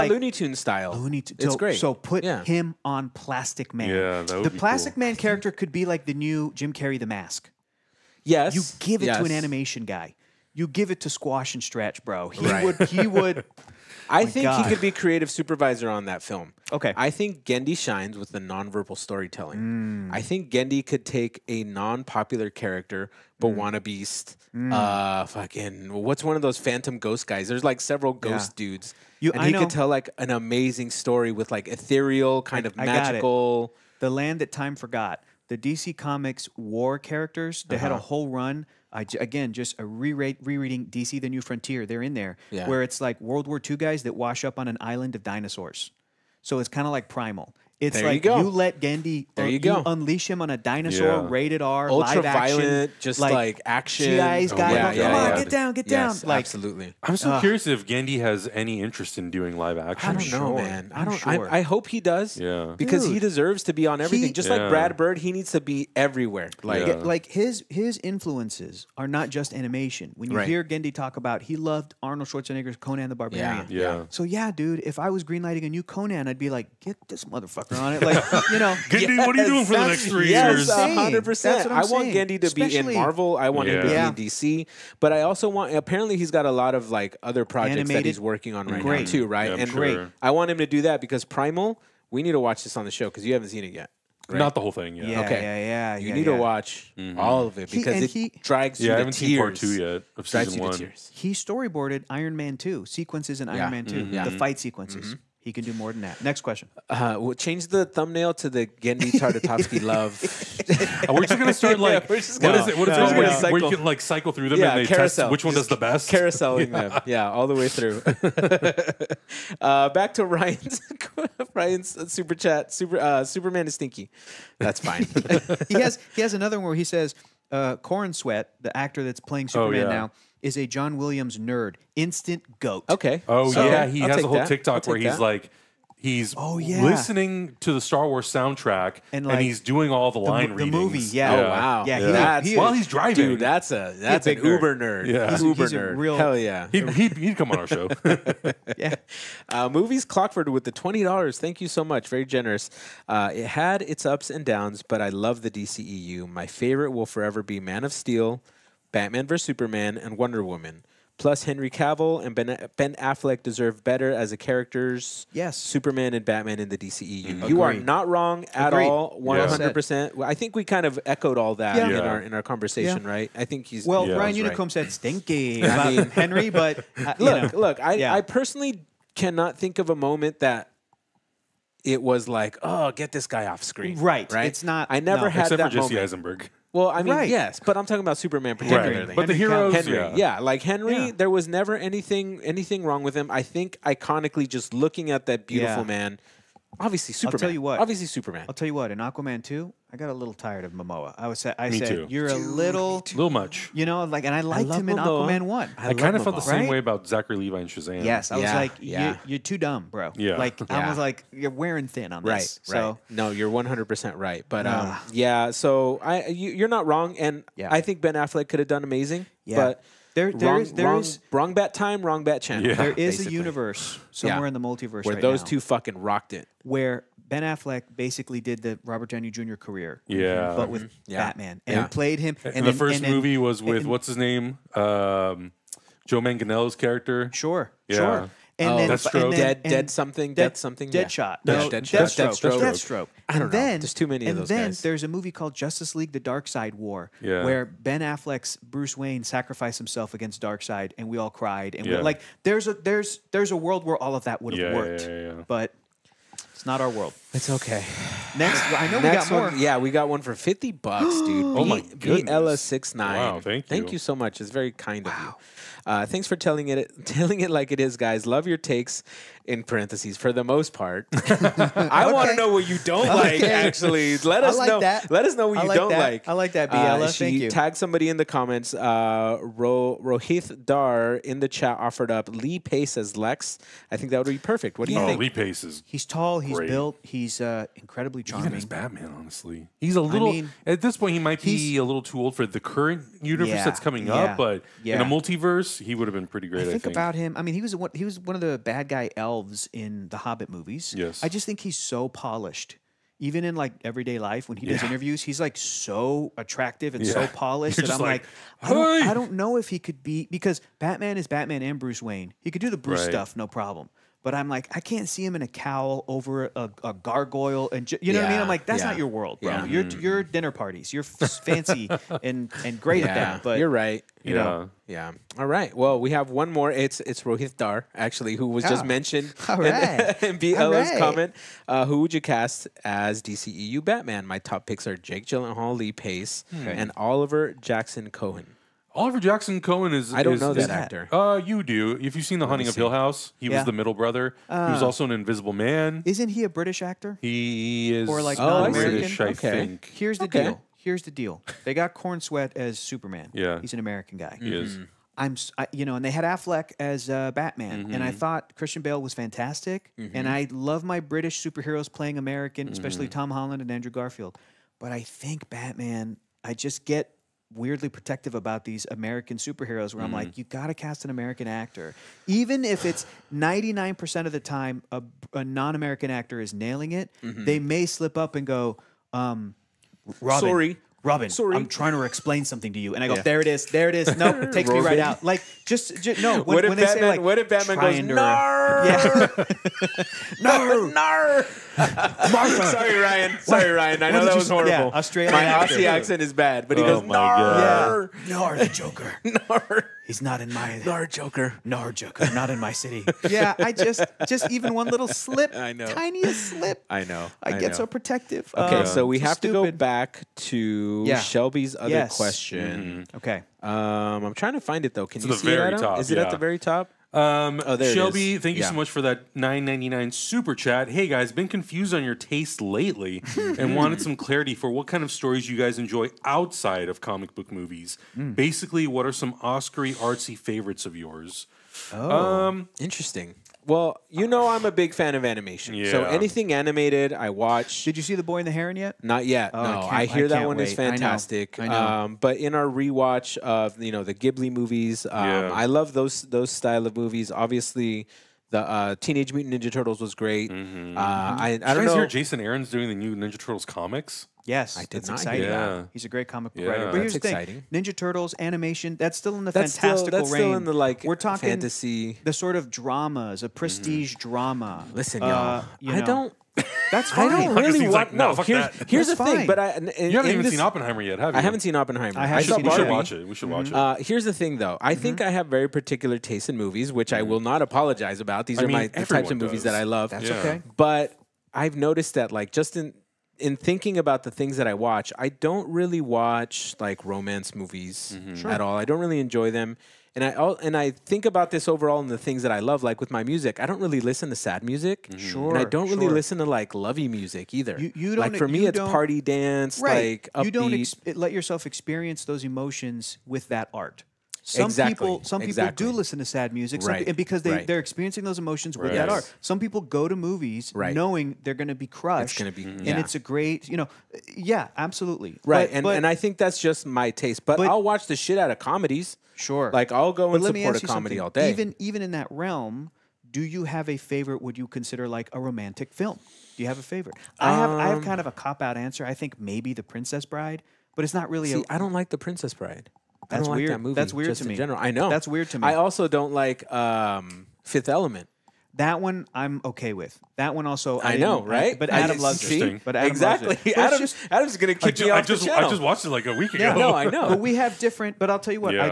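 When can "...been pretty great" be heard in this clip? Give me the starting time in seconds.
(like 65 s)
296 s.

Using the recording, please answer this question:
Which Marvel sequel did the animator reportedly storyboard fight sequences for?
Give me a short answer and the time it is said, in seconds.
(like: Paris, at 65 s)
Iron Man 2, at 103 s.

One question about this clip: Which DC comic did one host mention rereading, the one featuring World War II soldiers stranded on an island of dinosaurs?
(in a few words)
DC: The New Frontier.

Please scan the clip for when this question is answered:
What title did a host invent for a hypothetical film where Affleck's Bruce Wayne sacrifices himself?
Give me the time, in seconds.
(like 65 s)
245 s.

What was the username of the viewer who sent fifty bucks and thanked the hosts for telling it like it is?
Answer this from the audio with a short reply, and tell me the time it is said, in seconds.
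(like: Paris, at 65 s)
BLS69, at 262 s.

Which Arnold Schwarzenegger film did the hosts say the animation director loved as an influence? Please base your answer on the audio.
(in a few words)
Conan the Barbarian.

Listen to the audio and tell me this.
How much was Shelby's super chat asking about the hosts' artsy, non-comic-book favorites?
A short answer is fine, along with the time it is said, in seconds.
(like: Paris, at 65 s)
$9.99, at 419 s.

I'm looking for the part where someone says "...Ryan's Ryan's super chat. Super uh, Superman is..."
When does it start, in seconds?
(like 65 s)
120 s.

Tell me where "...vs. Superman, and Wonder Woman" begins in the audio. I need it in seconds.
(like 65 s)
159 s.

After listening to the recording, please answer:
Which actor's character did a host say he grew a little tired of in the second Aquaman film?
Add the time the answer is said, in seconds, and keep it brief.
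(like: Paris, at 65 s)
Momoa, at 200 s.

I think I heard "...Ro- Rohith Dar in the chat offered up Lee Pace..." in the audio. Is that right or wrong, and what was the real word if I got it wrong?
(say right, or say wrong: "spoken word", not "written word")
right.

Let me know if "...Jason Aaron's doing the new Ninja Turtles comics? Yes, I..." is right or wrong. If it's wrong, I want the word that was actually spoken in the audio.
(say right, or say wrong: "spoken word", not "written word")
right.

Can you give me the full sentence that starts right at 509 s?
Some people go to movies knowing they're going to be crushed.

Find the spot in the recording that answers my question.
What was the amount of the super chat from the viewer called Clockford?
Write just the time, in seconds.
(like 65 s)
150 s.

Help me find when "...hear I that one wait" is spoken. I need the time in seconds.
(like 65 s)
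440 s.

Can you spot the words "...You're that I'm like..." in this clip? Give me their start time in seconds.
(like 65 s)
307 s.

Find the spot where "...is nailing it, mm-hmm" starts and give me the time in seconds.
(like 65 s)
376 s.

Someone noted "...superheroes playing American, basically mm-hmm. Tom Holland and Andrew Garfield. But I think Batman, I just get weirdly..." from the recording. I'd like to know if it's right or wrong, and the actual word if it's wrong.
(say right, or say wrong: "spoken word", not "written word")
wrong: "especially", not "basically".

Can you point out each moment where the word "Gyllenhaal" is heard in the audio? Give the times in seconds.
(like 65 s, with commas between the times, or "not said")
335 s.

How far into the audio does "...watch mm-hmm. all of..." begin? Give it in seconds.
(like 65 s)
96 s.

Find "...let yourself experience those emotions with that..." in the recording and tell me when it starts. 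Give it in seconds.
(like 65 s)
501 s.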